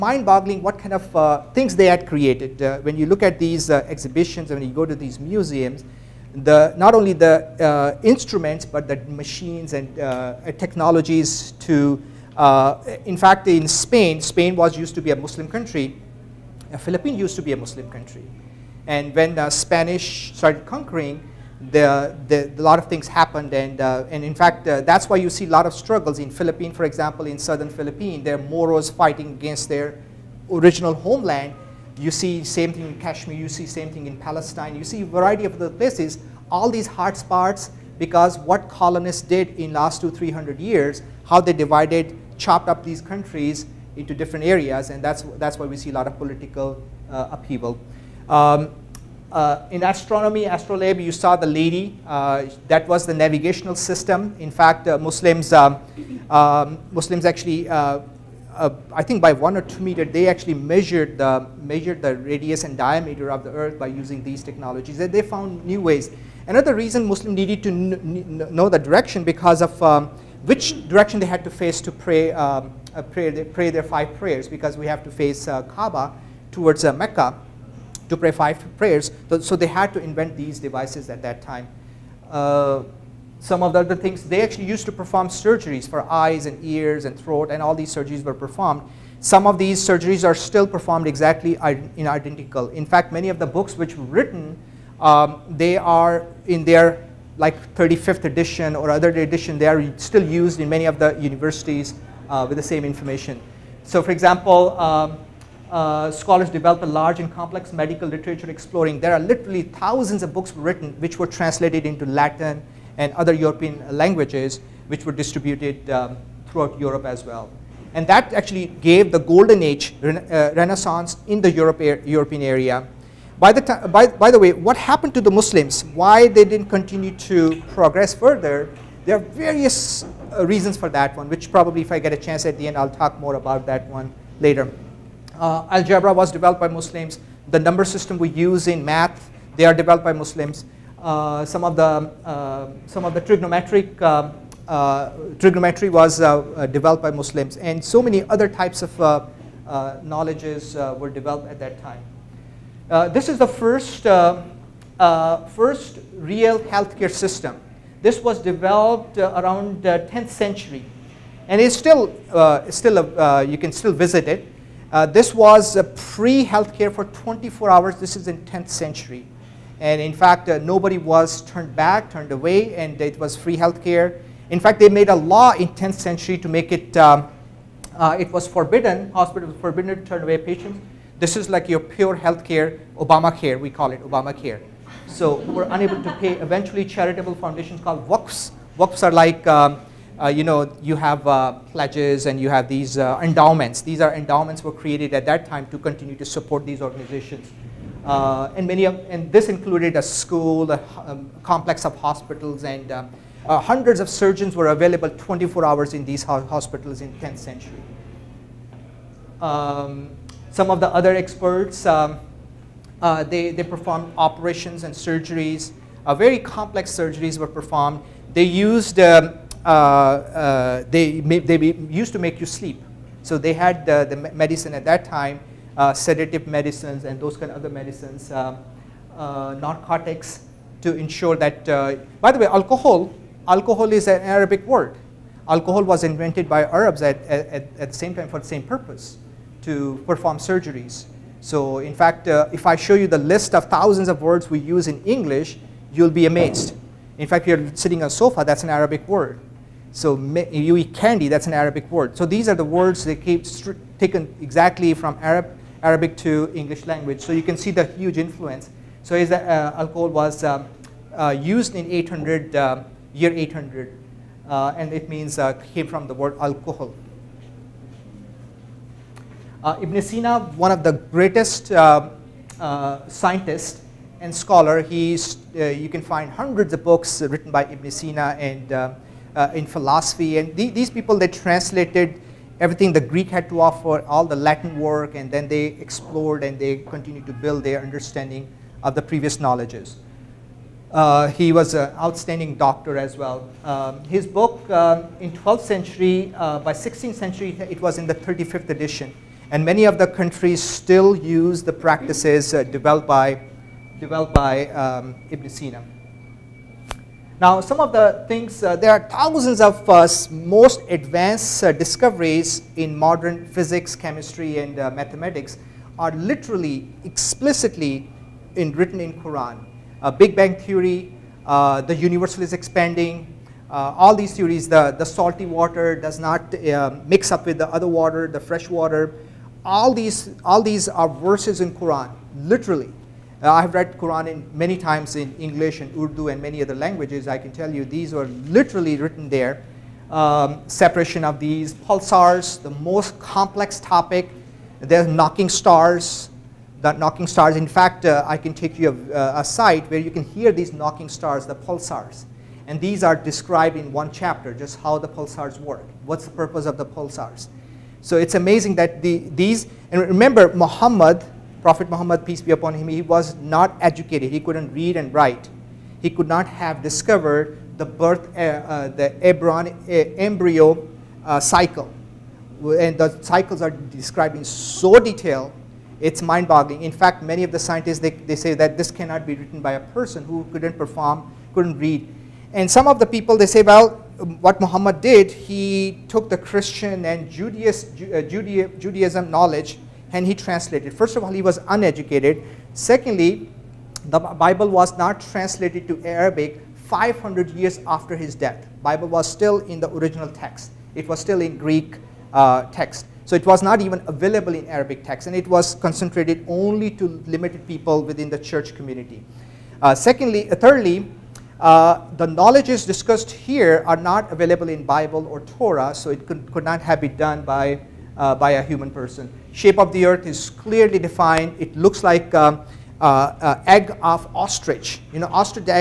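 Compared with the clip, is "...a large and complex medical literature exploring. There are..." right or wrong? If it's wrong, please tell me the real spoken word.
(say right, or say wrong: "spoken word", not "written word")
right.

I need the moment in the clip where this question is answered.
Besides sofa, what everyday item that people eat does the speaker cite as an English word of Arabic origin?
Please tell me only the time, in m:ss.
4:10.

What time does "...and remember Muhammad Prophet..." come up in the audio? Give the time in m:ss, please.
5:59.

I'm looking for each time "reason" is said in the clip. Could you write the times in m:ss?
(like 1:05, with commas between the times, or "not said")
1:06, 2:10.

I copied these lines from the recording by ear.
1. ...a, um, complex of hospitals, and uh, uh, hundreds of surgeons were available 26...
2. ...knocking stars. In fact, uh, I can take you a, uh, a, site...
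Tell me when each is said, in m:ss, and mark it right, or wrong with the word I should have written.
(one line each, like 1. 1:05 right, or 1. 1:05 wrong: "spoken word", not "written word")
1. 3:20 wrong: "24", not "26"
2. 5:47 right.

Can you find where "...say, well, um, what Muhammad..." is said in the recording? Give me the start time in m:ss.
6:23.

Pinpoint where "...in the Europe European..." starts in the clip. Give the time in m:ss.
2:01.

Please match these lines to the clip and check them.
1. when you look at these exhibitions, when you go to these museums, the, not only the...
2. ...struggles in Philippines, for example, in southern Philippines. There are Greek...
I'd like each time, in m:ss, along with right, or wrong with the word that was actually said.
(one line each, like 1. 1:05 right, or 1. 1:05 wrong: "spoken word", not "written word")
1. 0:02 right
2. 0:25 wrong: "Moros", not "Greek".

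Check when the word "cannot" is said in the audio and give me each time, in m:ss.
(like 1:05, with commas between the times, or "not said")
6:18.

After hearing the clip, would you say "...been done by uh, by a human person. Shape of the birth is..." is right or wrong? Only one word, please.
wrong.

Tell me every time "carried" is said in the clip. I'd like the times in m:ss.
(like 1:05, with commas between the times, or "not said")
not said.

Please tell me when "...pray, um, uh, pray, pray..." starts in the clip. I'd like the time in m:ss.
1:11.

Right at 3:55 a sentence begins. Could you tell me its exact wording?
Alcohol was invented by Arabs at, at, at the same time for the same purpose, to perform surgeries.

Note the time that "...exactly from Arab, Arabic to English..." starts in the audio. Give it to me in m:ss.
4:14.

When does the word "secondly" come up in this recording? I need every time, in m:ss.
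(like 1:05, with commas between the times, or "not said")
6:32, 6:49.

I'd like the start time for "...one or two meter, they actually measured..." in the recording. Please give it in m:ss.
0:59.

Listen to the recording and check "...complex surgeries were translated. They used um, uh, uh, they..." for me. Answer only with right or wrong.
wrong.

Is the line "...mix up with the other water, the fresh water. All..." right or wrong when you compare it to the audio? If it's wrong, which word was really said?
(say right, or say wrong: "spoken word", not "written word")
right.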